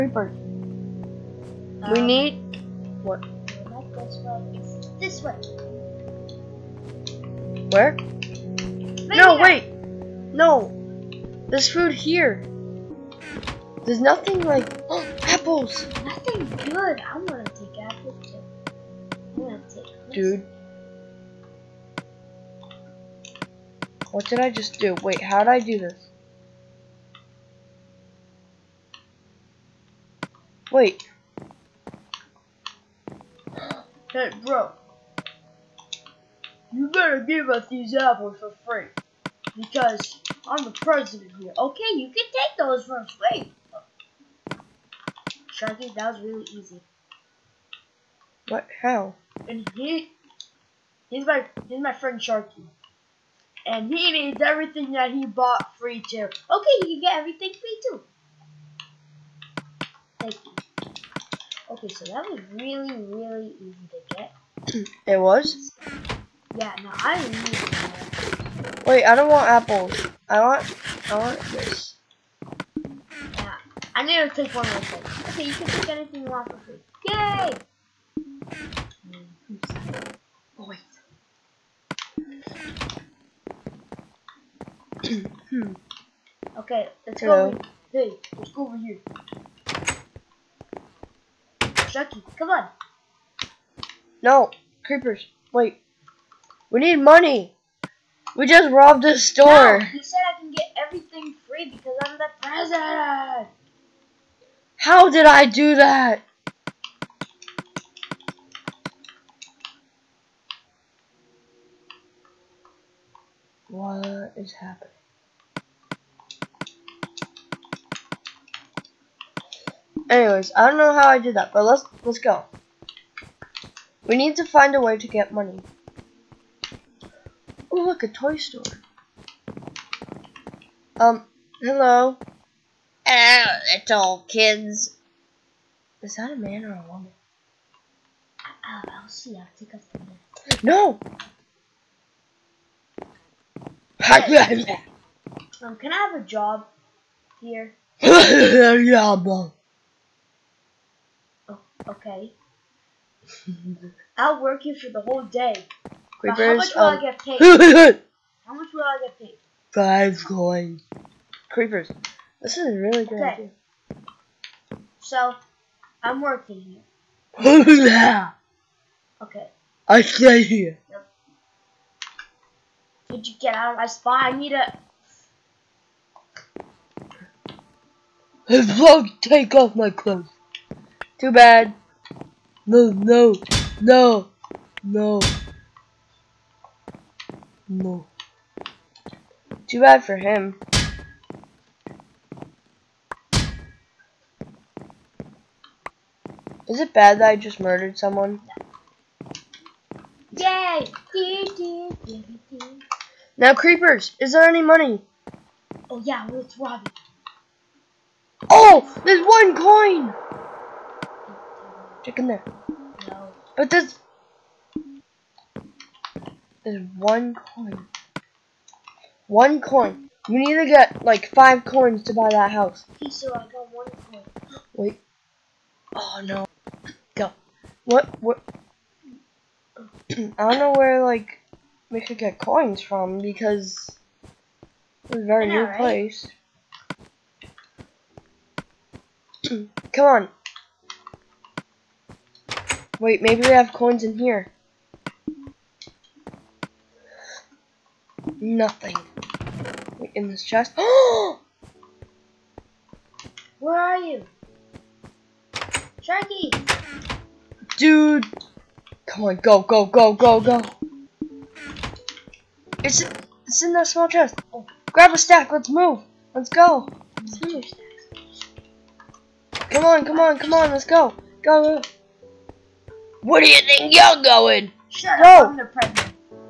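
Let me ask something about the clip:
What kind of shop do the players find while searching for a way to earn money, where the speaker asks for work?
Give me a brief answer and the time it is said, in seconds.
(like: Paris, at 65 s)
Toy store, at 128 s.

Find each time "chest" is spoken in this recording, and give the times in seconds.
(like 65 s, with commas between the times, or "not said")
250 s, 264 s.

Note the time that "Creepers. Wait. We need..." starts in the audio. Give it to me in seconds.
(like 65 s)
94 s.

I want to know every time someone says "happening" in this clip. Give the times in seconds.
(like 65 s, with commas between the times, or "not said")
114 s.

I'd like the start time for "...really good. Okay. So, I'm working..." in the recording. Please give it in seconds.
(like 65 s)
162 s.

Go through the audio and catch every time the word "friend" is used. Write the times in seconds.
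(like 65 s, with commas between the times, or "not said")
51 s.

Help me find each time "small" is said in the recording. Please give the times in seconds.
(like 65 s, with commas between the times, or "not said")
263 s.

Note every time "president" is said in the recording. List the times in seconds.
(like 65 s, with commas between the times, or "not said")
40 s, 102 s.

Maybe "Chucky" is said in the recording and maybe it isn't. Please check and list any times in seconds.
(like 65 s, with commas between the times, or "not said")
91 s.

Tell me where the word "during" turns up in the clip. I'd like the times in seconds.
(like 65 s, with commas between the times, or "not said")
not said.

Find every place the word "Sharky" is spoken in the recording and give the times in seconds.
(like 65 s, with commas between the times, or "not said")
45 s, 52 s, 256 s.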